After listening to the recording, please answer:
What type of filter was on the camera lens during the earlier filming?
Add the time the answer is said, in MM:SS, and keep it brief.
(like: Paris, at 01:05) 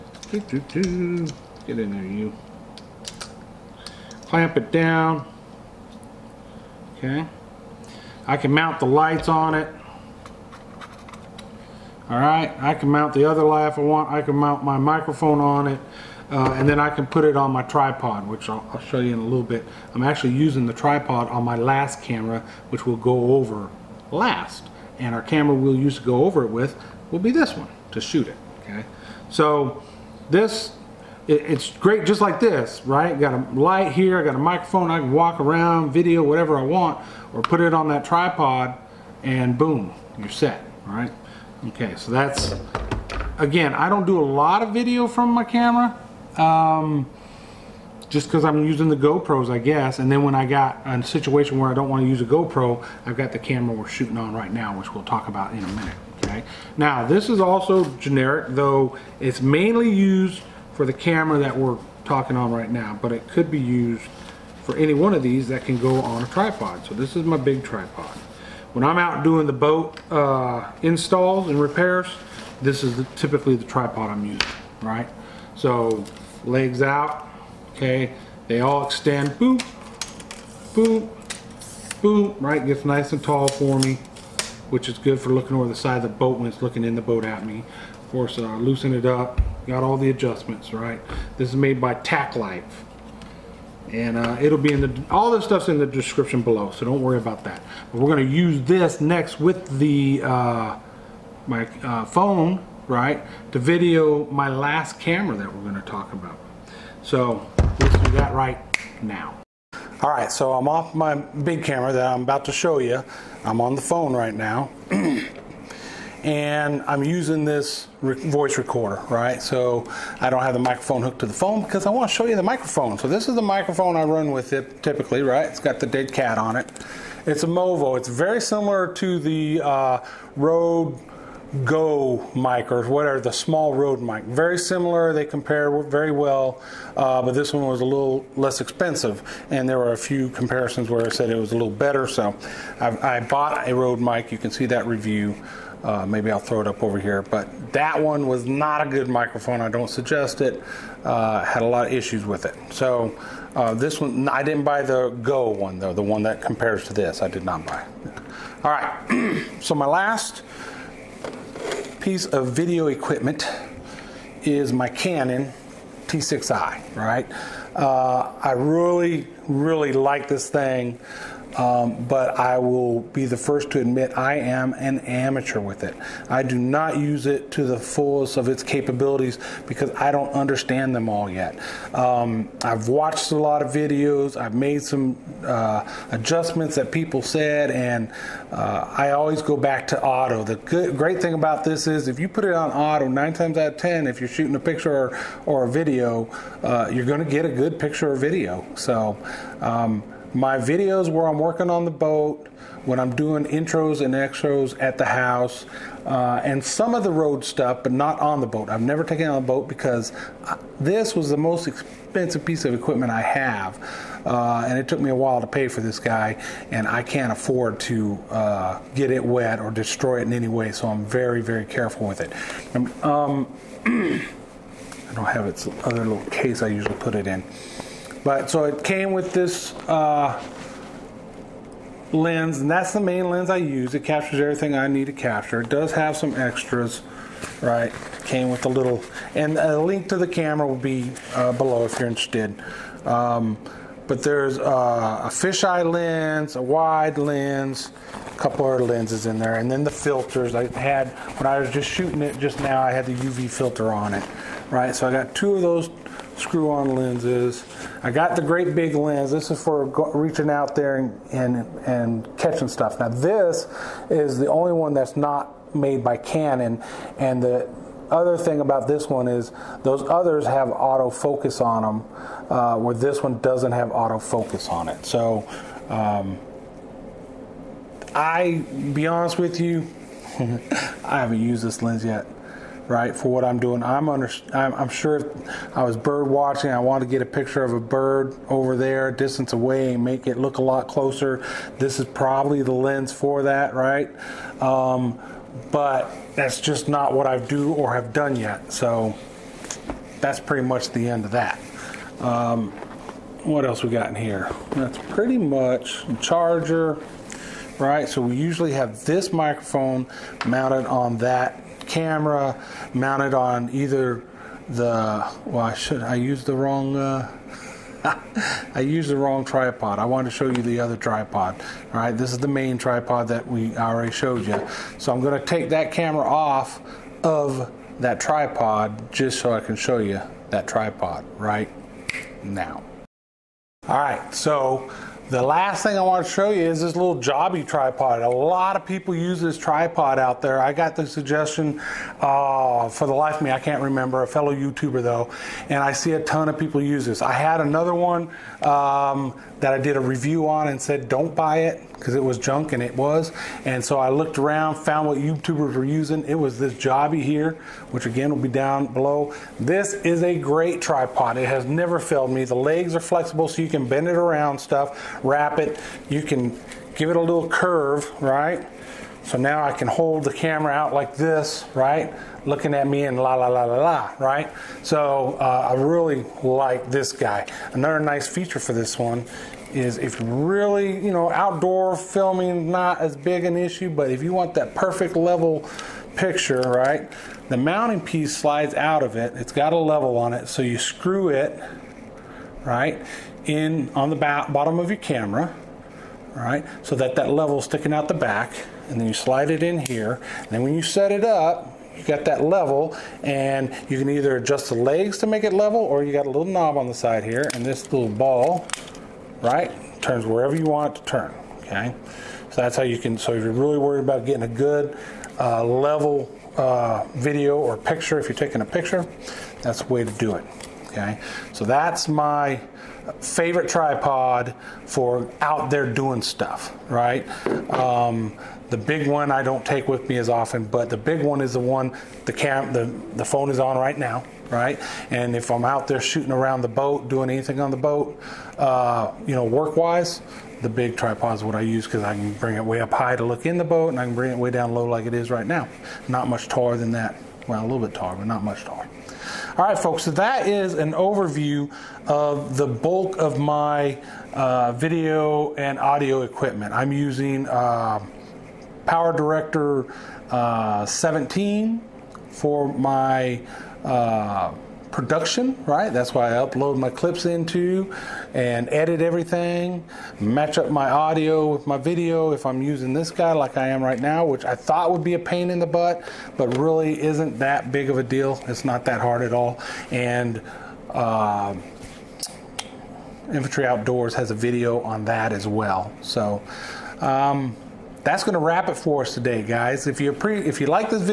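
UV filter, at 04:13.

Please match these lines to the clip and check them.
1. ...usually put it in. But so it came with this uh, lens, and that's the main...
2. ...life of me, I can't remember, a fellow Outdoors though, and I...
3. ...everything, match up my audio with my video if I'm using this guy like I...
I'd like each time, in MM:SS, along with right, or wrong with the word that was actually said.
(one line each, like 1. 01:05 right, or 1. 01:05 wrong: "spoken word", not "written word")
1. 03:46 right
2. 05:43 wrong: "YouTuber", not "Outdoors"
3. 07:49 right.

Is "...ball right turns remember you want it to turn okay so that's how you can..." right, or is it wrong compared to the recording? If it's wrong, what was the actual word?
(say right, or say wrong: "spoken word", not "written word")
wrong: "wherever", not "remember".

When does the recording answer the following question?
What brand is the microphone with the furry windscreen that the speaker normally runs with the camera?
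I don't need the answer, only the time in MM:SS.
02:07.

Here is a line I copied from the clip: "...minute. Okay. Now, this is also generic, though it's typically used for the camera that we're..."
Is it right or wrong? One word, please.
wrong.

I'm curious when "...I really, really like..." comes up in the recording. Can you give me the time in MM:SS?
02:48.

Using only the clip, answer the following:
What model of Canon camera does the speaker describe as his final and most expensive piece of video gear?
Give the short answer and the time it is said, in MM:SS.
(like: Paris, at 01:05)
Canon T6i, at 02:44.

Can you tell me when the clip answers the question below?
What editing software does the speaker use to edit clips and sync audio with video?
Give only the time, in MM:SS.
07:38.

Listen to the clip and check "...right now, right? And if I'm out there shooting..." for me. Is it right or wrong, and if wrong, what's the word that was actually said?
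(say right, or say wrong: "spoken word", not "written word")
right.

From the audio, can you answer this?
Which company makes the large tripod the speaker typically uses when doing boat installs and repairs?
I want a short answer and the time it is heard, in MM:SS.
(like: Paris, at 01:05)
Tacklife, at 01:31.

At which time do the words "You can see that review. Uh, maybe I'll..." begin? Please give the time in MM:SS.
02:24.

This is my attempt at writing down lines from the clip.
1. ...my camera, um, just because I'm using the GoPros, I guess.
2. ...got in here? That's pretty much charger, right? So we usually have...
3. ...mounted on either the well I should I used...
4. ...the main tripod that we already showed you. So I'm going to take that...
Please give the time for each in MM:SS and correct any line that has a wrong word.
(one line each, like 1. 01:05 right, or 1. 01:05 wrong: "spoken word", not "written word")
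1. 00:45 right
2. 05:03 right
3. 05:12 right
4. 05:22 right.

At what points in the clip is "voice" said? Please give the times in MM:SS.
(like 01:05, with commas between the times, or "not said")
01:58.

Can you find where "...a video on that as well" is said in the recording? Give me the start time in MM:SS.
08:04.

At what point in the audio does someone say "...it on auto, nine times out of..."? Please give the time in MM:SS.
03:12.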